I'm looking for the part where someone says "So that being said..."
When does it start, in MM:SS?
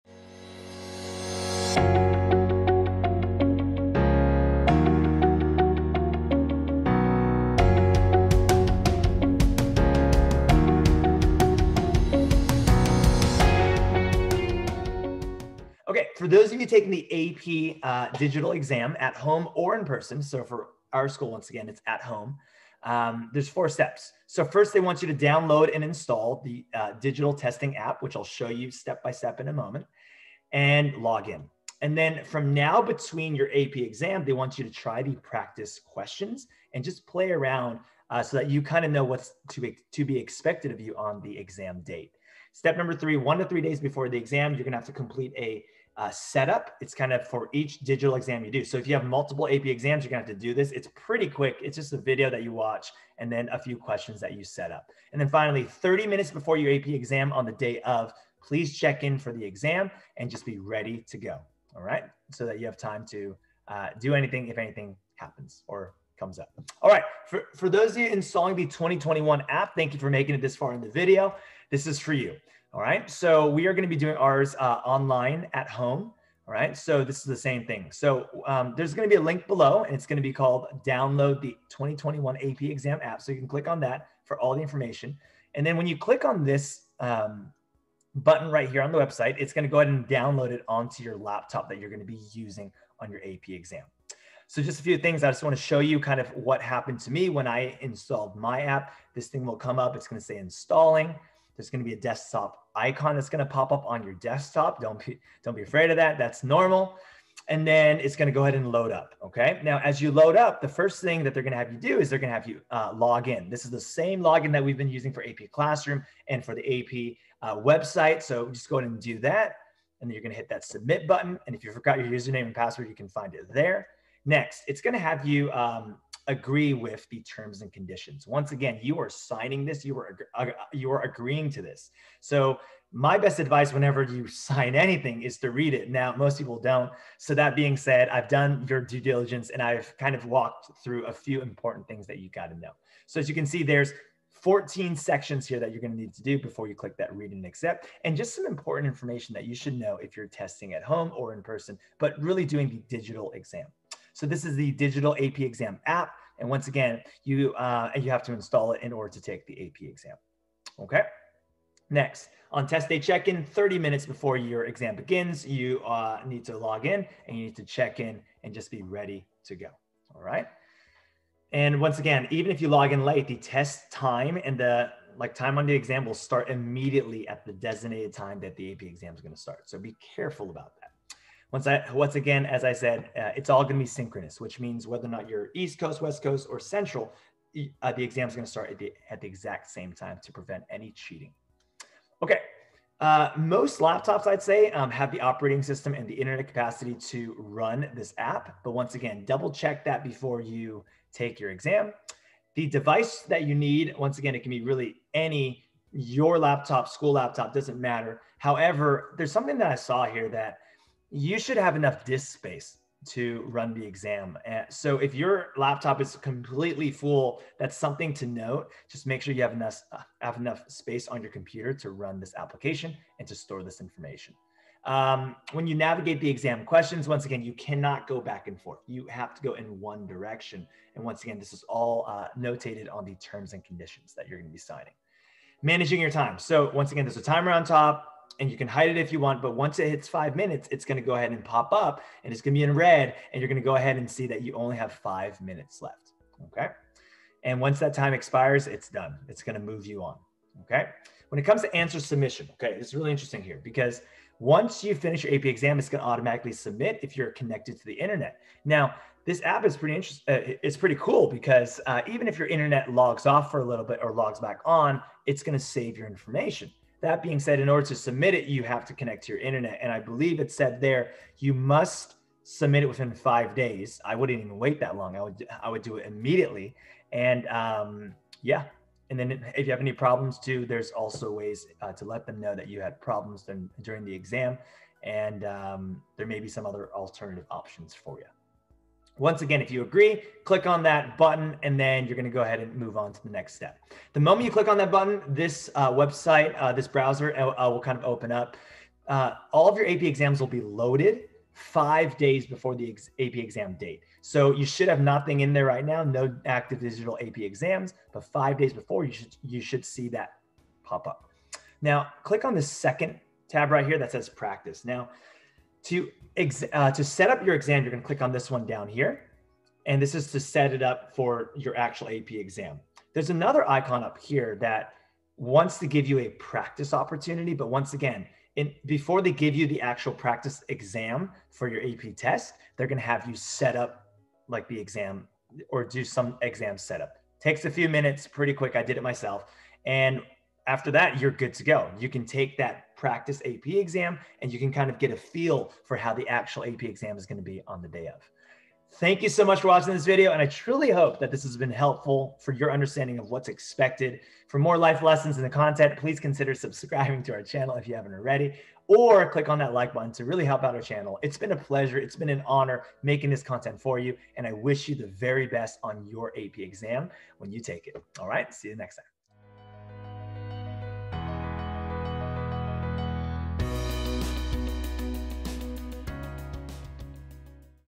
02:17.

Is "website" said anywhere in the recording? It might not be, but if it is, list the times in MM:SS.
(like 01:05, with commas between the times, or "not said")
01:28, 01:57, 04:55.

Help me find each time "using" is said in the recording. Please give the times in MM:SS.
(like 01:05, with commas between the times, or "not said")
01:32, 01:54.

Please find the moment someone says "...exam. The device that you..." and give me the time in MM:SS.
03:21.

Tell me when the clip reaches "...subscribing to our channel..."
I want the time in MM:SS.
05:56.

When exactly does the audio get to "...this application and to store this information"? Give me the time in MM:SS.
03:42.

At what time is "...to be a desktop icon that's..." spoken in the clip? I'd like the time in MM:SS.
01:41.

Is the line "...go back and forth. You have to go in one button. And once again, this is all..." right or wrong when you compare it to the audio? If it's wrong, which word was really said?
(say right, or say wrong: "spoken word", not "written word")
wrong: "direction", not "button".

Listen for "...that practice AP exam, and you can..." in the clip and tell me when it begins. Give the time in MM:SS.
05:42.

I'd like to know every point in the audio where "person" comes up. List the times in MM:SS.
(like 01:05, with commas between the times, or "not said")
00:19, 02:31.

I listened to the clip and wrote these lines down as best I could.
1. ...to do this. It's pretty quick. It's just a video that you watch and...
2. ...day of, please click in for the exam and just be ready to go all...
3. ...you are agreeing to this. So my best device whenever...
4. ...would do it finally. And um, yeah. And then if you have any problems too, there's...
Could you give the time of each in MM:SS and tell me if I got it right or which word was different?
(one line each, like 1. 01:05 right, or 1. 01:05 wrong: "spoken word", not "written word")
1. 00:50 right
2. 00:57 wrong: "check", not "click"
3. 02:10 wrong: "advice", not "device"
4. 04:35 wrong: "immediately", not "finally".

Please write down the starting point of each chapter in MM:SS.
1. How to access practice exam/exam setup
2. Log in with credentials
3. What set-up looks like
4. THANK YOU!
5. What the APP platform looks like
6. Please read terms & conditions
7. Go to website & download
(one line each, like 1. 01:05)
1. 05:11
2. 01:50
3. 01:34
4. 05:47
5. 04:53
6. 02:03
7. 01:06.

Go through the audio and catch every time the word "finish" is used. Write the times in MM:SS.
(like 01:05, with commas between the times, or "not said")
04:14.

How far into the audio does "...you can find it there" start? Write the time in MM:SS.
02:02.